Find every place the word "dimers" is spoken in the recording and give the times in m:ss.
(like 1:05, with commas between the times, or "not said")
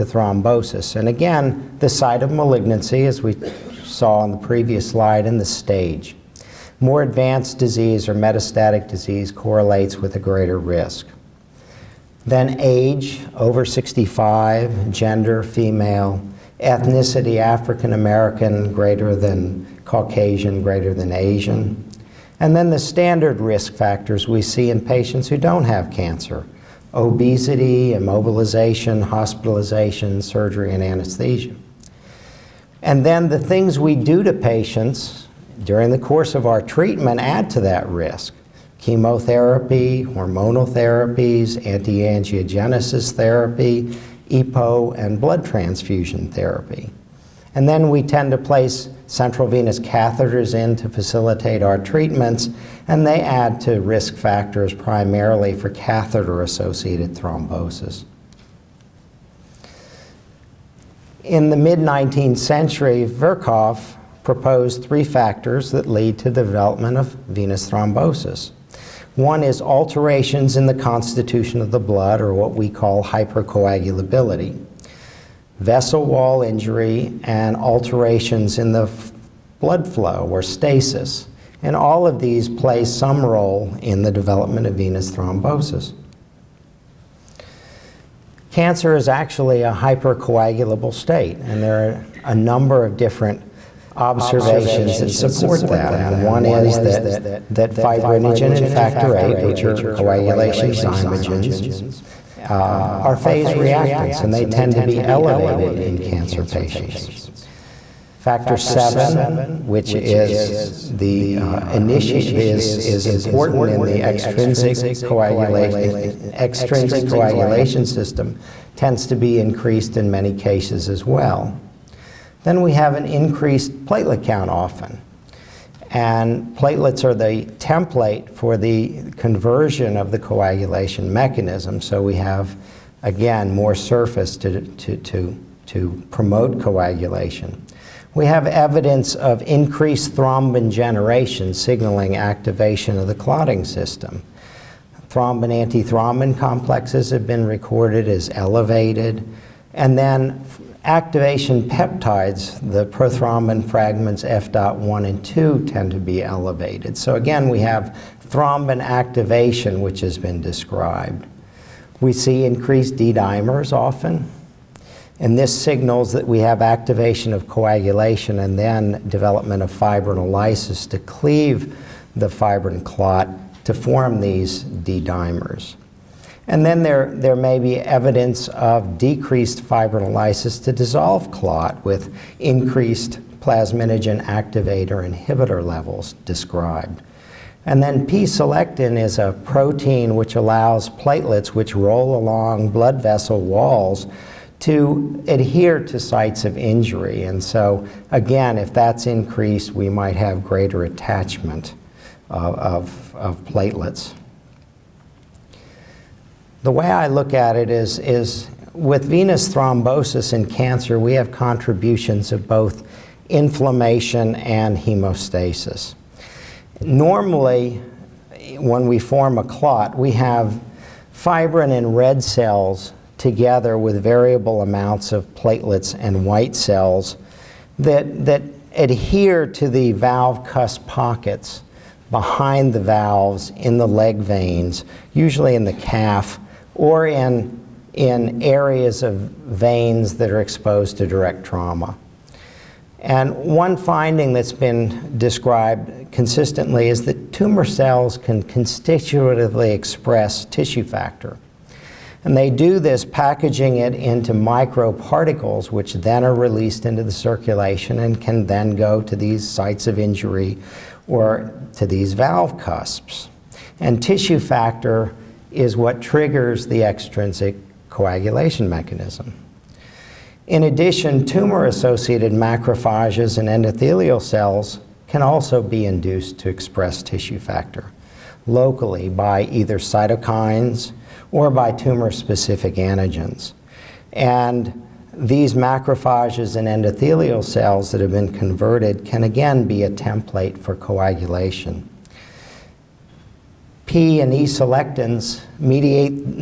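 2:42, 2:54.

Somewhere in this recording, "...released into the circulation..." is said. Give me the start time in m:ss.
4:16.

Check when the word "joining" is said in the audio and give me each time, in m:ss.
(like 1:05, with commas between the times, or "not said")
not said.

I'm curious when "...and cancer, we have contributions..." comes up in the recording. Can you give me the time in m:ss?
3:30.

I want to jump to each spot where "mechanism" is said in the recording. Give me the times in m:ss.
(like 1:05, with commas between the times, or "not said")
2:11, 4:28.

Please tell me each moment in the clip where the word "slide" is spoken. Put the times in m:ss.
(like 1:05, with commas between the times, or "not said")
0:04.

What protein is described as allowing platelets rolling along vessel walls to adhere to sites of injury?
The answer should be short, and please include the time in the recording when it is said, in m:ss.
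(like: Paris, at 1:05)
P-selectin, at 3:08.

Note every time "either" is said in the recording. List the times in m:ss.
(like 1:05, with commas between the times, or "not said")
4:39.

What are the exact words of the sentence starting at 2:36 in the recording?
So again, we have thrombin activation, which has been described.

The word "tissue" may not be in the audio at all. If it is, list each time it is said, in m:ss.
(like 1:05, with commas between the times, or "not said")
4:10, 4:24, 4:37.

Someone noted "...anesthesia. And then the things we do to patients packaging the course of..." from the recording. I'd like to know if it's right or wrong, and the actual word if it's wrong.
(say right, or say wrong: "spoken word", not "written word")
wrong: "during", not "packaging".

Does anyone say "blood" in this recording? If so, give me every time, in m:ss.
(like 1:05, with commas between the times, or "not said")
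0:45, 1:11, 1:19, 3:12.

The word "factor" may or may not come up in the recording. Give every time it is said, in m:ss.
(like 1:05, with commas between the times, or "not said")
0:23, 0:54, 1:05, 1:38, 1:48, 4:10, 4:24, 4:37.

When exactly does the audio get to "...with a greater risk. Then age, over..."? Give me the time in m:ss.
0:09.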